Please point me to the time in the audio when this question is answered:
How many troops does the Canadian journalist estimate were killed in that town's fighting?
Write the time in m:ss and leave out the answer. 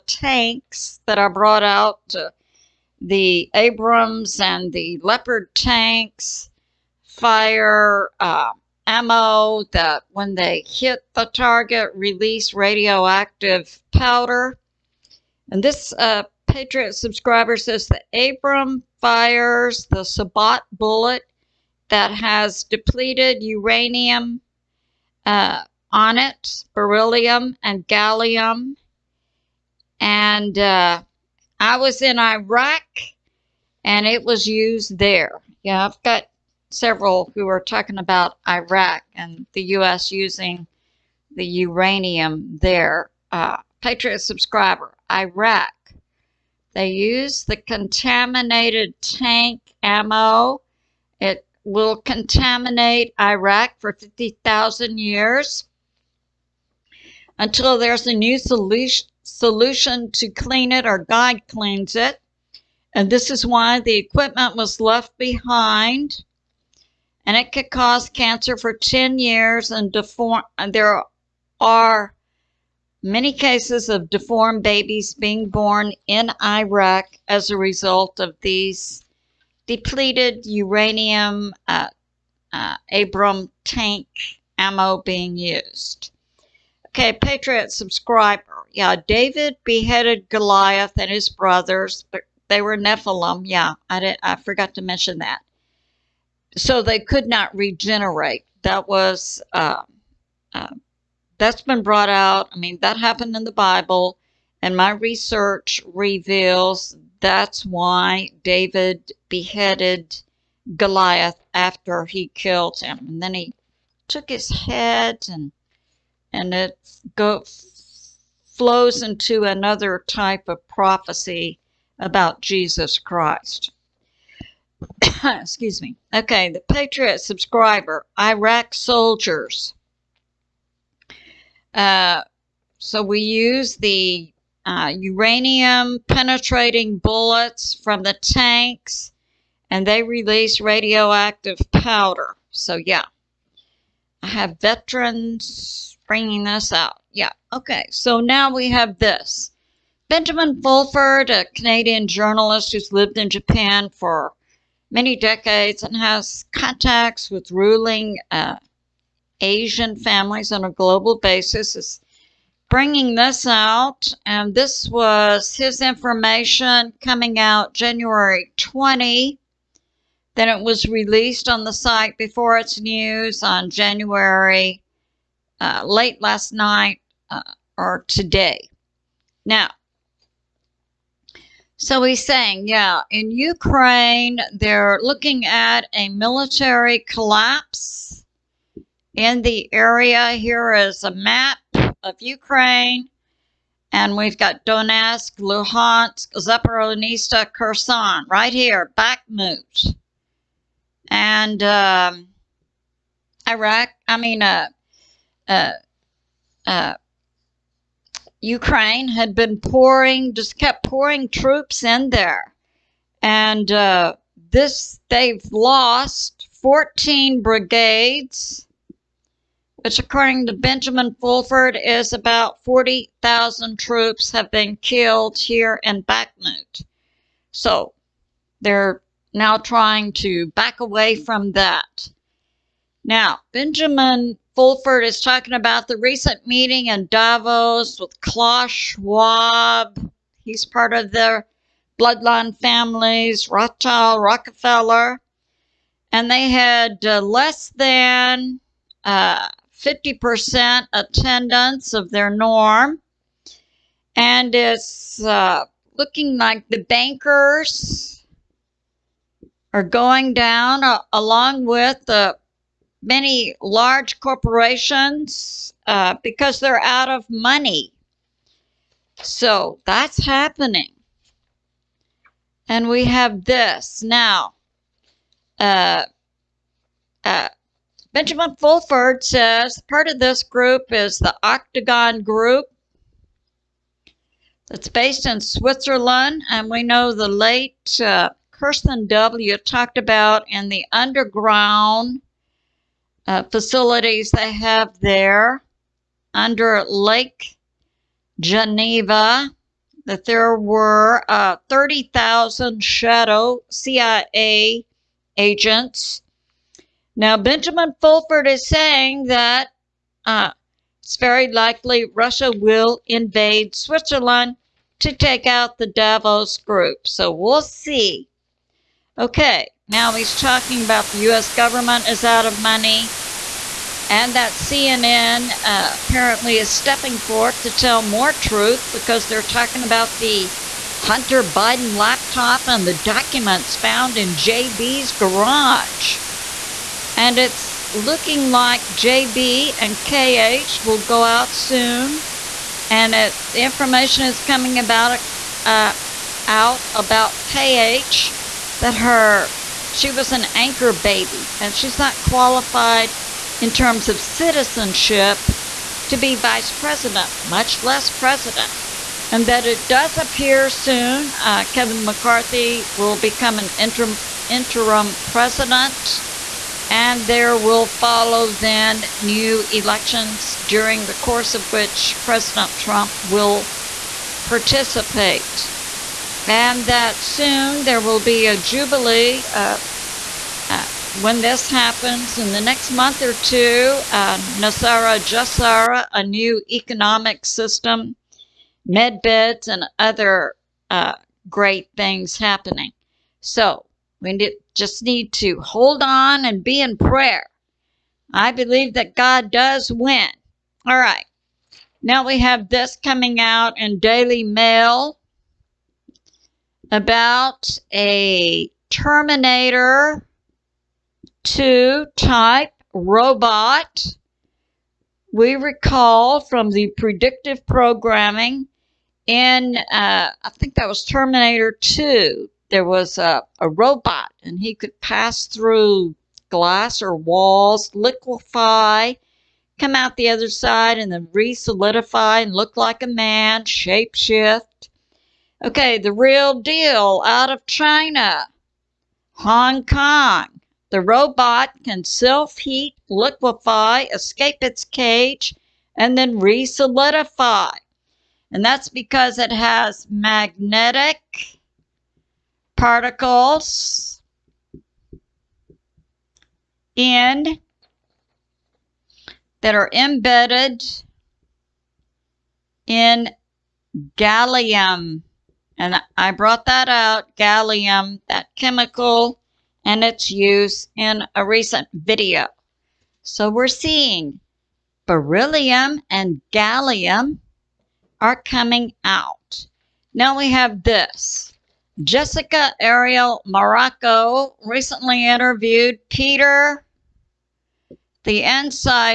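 3:42.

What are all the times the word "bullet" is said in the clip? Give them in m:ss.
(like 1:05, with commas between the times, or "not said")
0:20, 2:16.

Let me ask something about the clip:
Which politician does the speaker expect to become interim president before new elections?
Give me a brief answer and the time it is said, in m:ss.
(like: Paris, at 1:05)
Kevin McCarthy, at 6:01.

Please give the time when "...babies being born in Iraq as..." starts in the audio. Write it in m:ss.
1:14.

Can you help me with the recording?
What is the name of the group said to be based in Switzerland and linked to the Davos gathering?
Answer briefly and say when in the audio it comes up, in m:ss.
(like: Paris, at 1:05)
Octagon Group, at 4:41.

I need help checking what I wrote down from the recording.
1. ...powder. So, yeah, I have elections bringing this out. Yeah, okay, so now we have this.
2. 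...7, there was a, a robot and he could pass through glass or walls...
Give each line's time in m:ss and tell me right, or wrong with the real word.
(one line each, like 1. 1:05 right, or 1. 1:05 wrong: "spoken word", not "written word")
1. 2:21 wrong: "veterans", not "elections"
2. 7:01 wrong: "2", not "7".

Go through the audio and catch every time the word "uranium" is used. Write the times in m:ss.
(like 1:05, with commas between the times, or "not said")
0:23, 0:41, 1:20, 2:14.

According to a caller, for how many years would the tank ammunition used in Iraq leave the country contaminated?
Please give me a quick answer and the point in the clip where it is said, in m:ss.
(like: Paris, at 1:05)
50,000 years, at 0:53.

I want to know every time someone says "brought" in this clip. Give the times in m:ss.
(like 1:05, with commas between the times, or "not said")
0:01, 1:41, 7:46.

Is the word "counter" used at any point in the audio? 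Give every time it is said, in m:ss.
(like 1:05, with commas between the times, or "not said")
not said.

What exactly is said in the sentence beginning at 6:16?
And that soon there will be a jubilee uh, uh, when this happens.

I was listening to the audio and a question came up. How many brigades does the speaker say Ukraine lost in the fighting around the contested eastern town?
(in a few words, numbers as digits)
14.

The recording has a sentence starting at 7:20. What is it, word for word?
The robot can self heat, liquefy, escape its cage, and then re solidify.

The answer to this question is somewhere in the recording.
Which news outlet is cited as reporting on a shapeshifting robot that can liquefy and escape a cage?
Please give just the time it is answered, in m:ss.
6:43.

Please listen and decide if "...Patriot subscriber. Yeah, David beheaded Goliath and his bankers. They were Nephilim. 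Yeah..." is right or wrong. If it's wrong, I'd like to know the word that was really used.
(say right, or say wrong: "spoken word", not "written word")
wrong: "brothers", not "bankers".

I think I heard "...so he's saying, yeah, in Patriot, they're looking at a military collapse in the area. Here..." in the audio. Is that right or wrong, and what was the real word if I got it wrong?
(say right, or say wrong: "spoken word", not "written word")
wrong: "Ukraine", not "Patriot".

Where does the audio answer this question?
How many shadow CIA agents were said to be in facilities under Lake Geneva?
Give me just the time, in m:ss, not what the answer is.
5:01.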